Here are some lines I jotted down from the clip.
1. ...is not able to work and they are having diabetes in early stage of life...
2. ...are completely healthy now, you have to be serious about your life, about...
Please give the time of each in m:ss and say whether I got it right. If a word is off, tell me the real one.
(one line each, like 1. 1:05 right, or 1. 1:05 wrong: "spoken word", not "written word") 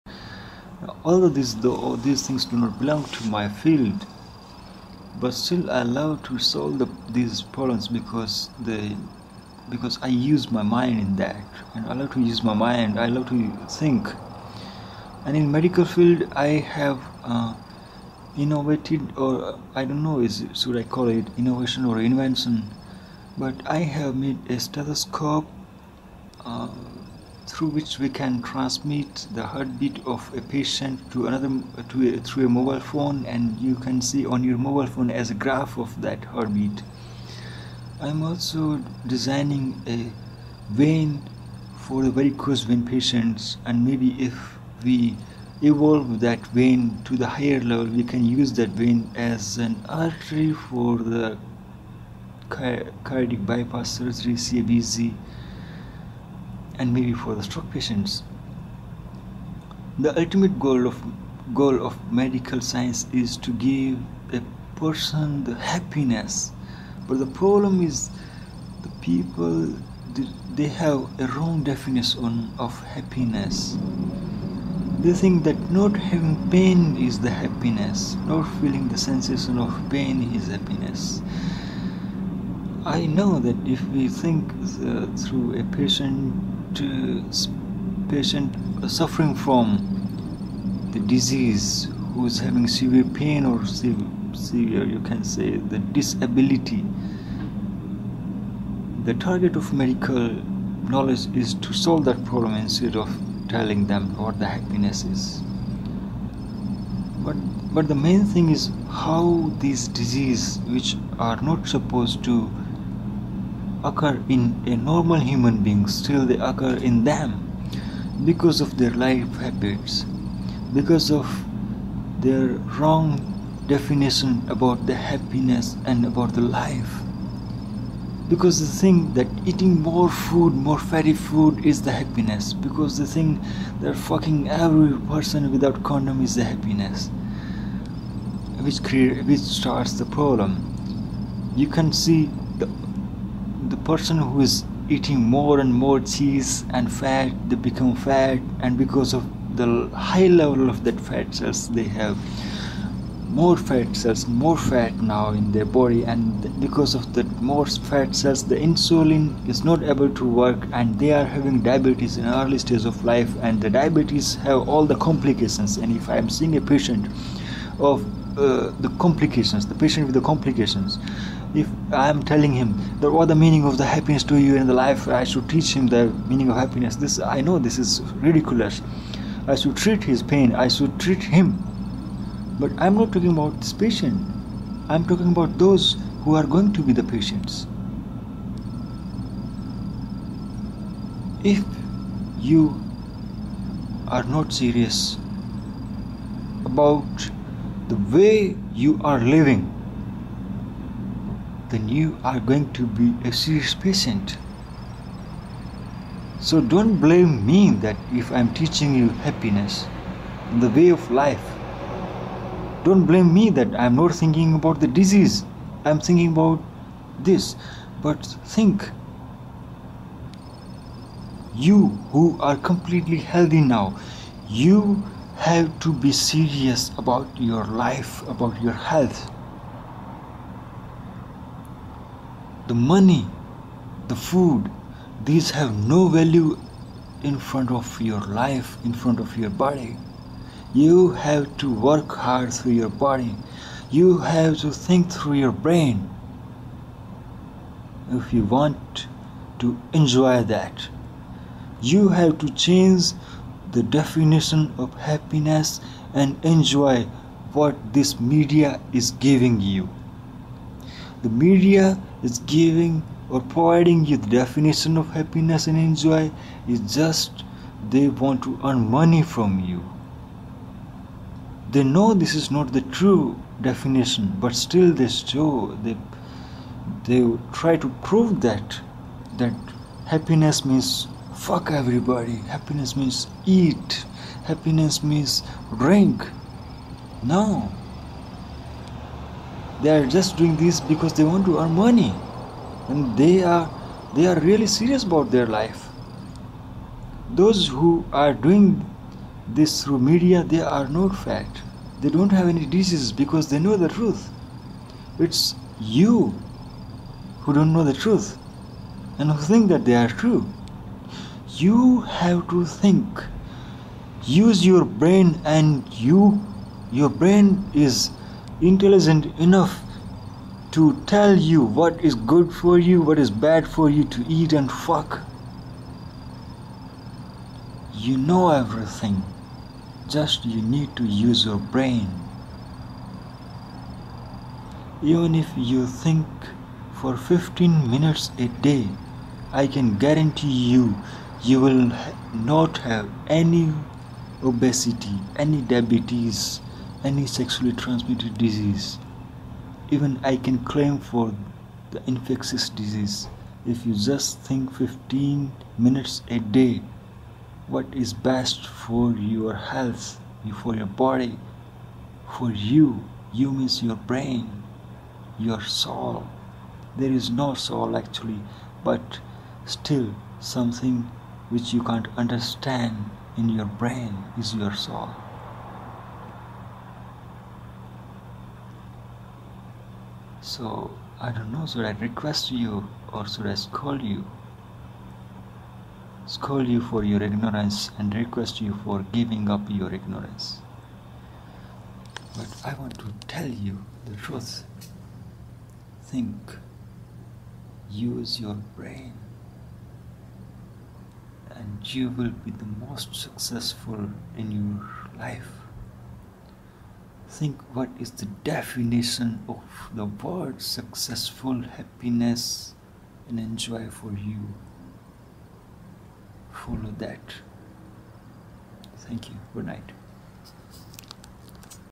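1. 2:39 right
2. 3:42 right.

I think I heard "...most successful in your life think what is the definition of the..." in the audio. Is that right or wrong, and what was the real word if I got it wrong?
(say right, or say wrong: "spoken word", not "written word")
right.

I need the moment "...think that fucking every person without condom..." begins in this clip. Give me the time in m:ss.
2:13.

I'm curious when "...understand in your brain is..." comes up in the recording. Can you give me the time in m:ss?
6:12.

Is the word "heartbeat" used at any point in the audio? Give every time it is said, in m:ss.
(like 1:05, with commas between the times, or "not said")
0:29, 0:36.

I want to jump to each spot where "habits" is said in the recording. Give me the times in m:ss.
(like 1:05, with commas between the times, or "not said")
1:59.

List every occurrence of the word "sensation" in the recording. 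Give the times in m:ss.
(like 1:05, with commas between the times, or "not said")
1:18.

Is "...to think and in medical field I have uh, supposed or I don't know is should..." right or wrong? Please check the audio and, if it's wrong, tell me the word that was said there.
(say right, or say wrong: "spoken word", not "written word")
wrong: "innovated", not "supposed".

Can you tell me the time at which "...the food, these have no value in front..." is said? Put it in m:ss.
3:54.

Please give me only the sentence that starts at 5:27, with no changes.
You know everything, just you need to use your brain.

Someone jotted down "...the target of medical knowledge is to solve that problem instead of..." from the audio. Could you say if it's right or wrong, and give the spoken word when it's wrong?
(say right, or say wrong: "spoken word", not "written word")
right.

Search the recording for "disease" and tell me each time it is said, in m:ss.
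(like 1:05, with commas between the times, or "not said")
1:31, 1:50, 3:34, 5:02, 5:48, 5:52.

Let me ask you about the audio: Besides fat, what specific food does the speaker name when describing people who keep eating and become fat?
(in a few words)
cheese.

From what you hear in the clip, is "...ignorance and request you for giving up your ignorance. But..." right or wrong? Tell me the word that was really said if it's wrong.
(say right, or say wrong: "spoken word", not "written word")
right.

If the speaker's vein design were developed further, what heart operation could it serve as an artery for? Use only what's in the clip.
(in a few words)
cardiac bypass surgery.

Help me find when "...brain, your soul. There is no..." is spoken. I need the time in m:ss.
6:03.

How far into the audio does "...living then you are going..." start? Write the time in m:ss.
3:19.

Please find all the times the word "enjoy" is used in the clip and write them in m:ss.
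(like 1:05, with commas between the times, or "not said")
4:09, 4:16, 4:25, 6:53.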